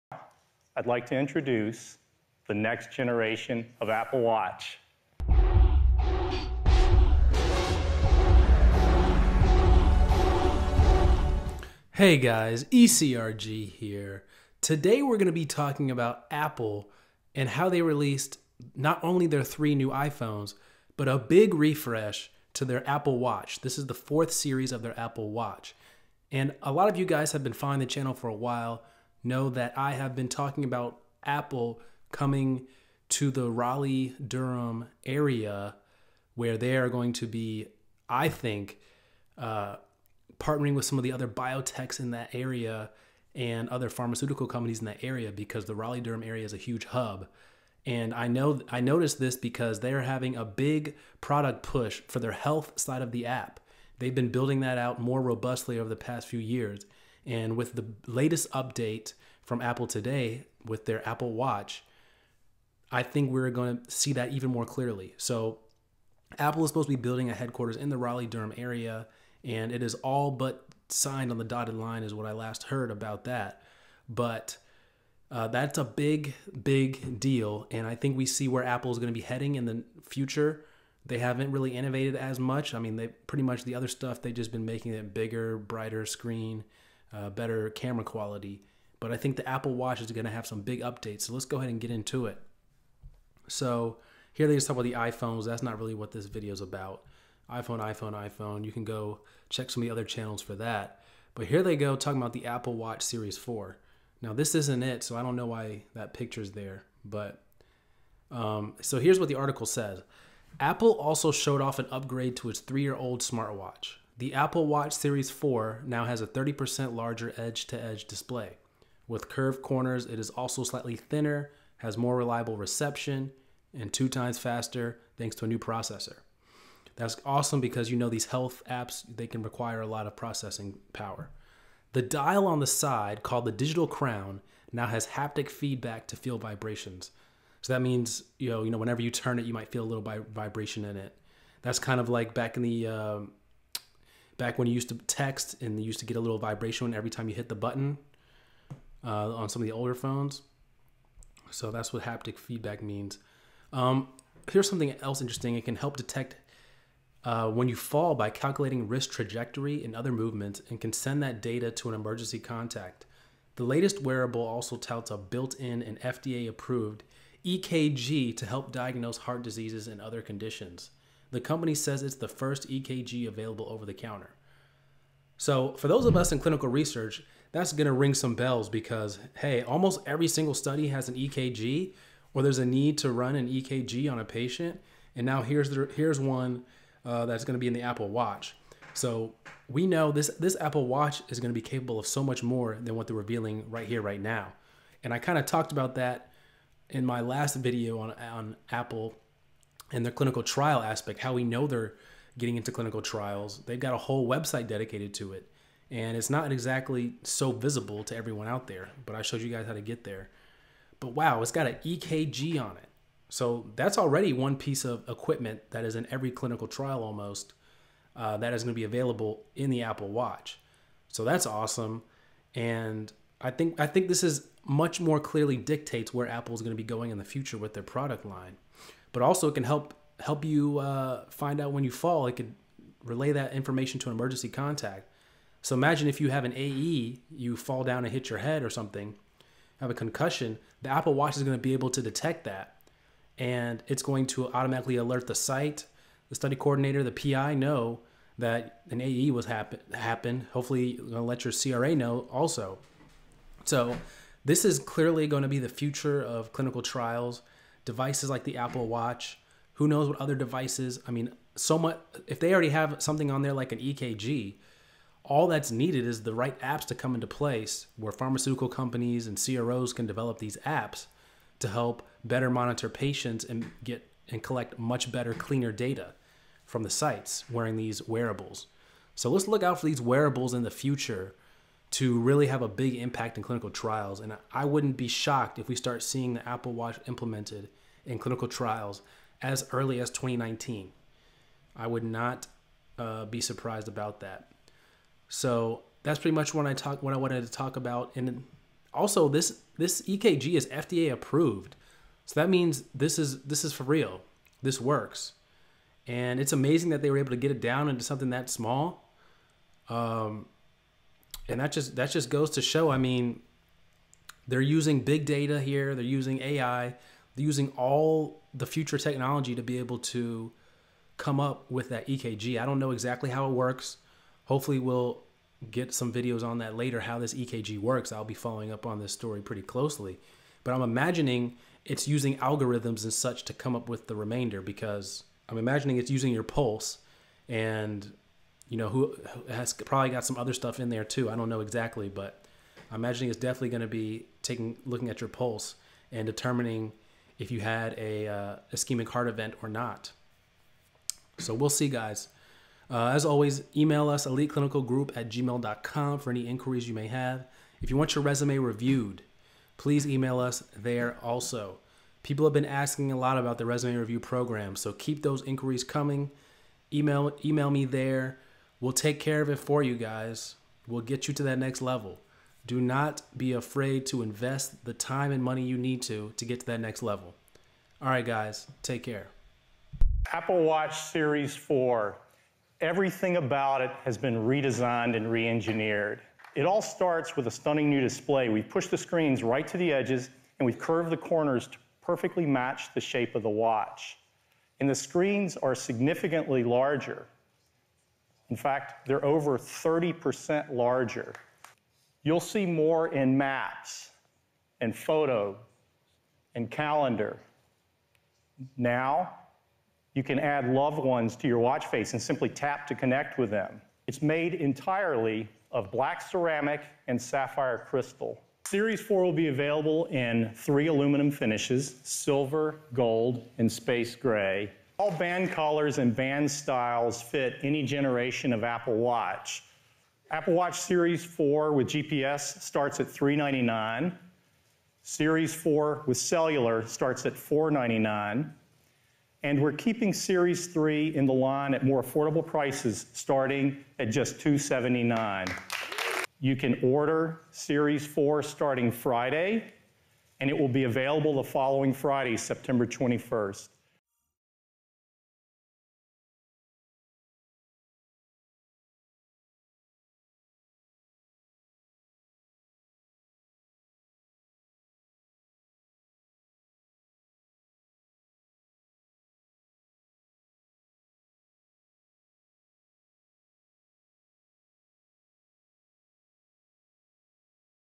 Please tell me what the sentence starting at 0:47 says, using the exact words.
And I know I noticed this because they are having a big product push for their health side of the app.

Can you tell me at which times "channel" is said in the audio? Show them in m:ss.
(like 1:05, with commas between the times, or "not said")
0:27, 1:40.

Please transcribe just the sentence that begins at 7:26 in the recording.
You can order Series 4 starting Friday, and it will be available the following Friday, September 21st.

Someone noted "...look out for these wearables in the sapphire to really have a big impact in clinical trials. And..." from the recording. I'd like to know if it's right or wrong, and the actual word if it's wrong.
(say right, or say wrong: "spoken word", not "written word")
wrong: "future", not "sapphire".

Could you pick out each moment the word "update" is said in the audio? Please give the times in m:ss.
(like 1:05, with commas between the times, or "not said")
0:58, 1:30.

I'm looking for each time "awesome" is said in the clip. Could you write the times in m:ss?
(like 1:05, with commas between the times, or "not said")
2:07, 3:41.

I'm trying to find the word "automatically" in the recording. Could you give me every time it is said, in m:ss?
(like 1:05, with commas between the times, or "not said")
4:04.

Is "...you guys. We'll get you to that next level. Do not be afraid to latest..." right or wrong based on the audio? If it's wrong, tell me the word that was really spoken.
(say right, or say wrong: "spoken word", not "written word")
wrong: "invest", not "latest".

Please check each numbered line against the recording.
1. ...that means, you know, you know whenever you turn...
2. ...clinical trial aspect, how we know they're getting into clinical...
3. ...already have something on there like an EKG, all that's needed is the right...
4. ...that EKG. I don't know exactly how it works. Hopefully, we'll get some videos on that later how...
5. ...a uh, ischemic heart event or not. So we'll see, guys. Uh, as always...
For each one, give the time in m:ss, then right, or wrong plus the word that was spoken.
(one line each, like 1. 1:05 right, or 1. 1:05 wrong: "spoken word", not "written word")
1. 2:17 right
2. 3:20 right
3. 4:22 right
4. 5:21 right
5. 5:47 right.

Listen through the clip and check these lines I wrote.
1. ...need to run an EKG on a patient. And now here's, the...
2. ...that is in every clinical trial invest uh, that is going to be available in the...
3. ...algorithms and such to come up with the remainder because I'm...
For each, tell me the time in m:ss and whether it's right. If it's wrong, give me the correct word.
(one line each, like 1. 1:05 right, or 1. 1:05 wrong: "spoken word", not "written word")
1. 3:02 right
2. 3:35 wrong: "almost", not "invest"
3. 5:32 right.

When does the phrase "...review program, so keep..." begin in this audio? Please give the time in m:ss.
6:03.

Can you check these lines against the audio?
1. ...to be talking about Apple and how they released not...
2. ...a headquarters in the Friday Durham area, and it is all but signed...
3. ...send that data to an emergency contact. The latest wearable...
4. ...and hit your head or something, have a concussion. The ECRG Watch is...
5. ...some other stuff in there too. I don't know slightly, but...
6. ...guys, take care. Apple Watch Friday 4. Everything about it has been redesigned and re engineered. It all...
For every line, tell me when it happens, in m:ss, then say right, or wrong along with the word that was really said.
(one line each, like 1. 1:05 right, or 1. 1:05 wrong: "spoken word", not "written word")
1. 0:15 right
2. 1:07 wrong: "Raleigh", not "Friday"
3. 2:40 right
4. 3:58 wrong: "Apple", not "ECRG"
5. 5:40 wrong: "exactly", not "slightly"
6. 6:18 wrong: "Series", not "Friday".